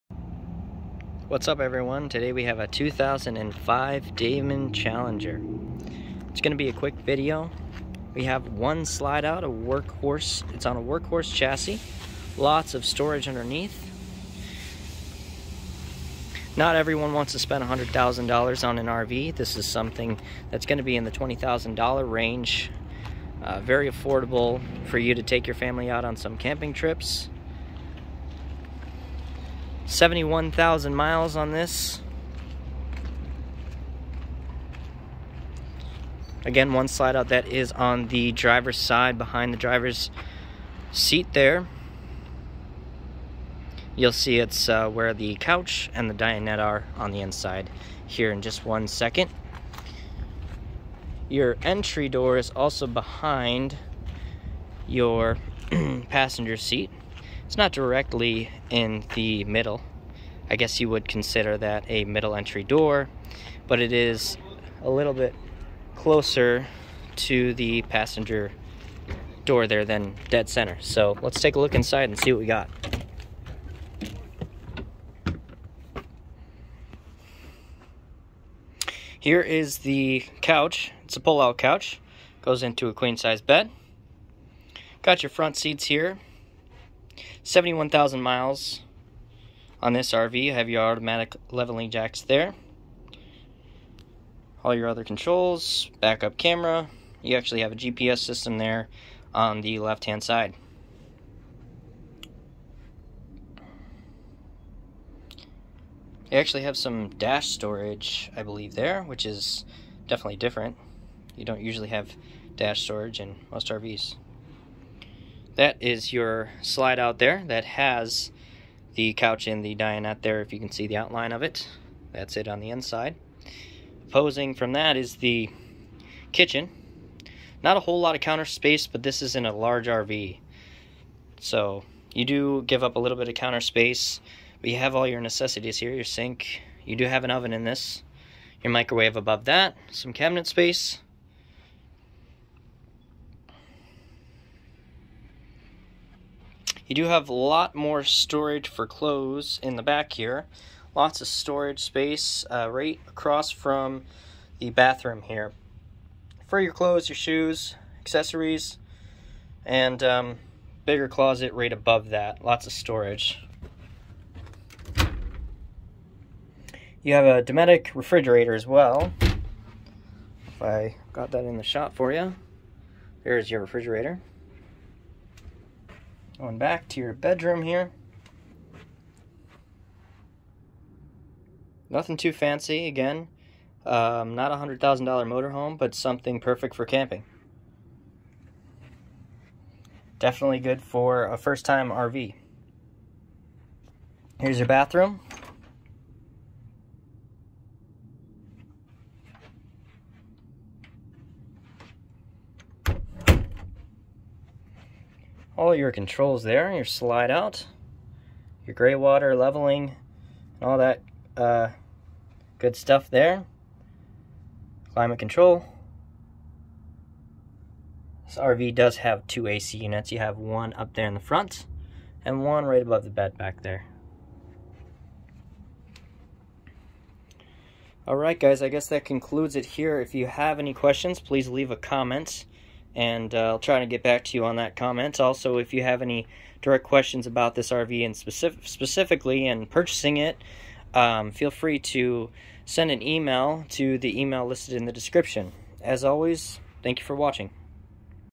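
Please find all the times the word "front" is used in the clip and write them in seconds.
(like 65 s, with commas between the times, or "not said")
85 s, 221 s.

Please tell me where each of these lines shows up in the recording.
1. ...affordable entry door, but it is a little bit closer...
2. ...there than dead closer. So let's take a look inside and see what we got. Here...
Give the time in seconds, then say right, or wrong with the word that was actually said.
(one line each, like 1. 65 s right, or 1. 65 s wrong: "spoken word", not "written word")
1. 62 s wrong: "middle", not "affordable"
2. 69 s wrong: "center", not "closer".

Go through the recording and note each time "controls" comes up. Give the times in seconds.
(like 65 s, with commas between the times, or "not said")
95 s, 205 s, 215 s.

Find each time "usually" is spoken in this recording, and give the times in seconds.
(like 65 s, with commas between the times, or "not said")
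111 s.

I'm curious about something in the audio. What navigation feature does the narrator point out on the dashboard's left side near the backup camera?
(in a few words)
GPS system.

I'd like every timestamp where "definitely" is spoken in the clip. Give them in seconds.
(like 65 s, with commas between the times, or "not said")
110 s, 190 s.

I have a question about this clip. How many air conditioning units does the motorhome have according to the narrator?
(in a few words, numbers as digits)
2.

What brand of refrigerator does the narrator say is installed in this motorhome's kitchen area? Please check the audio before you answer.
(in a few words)
Dometic.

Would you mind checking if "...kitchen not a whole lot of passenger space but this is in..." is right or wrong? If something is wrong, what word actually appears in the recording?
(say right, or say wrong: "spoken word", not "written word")
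wrong: "counter", not "passenger".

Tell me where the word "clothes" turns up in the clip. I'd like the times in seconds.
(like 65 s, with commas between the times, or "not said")
148 s, 156 s.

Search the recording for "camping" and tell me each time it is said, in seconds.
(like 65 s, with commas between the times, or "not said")
26 s, 186 s.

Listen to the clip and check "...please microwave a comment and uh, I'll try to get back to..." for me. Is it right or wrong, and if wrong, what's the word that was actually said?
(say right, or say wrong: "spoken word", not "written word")
wrong: "leave", not "microwave".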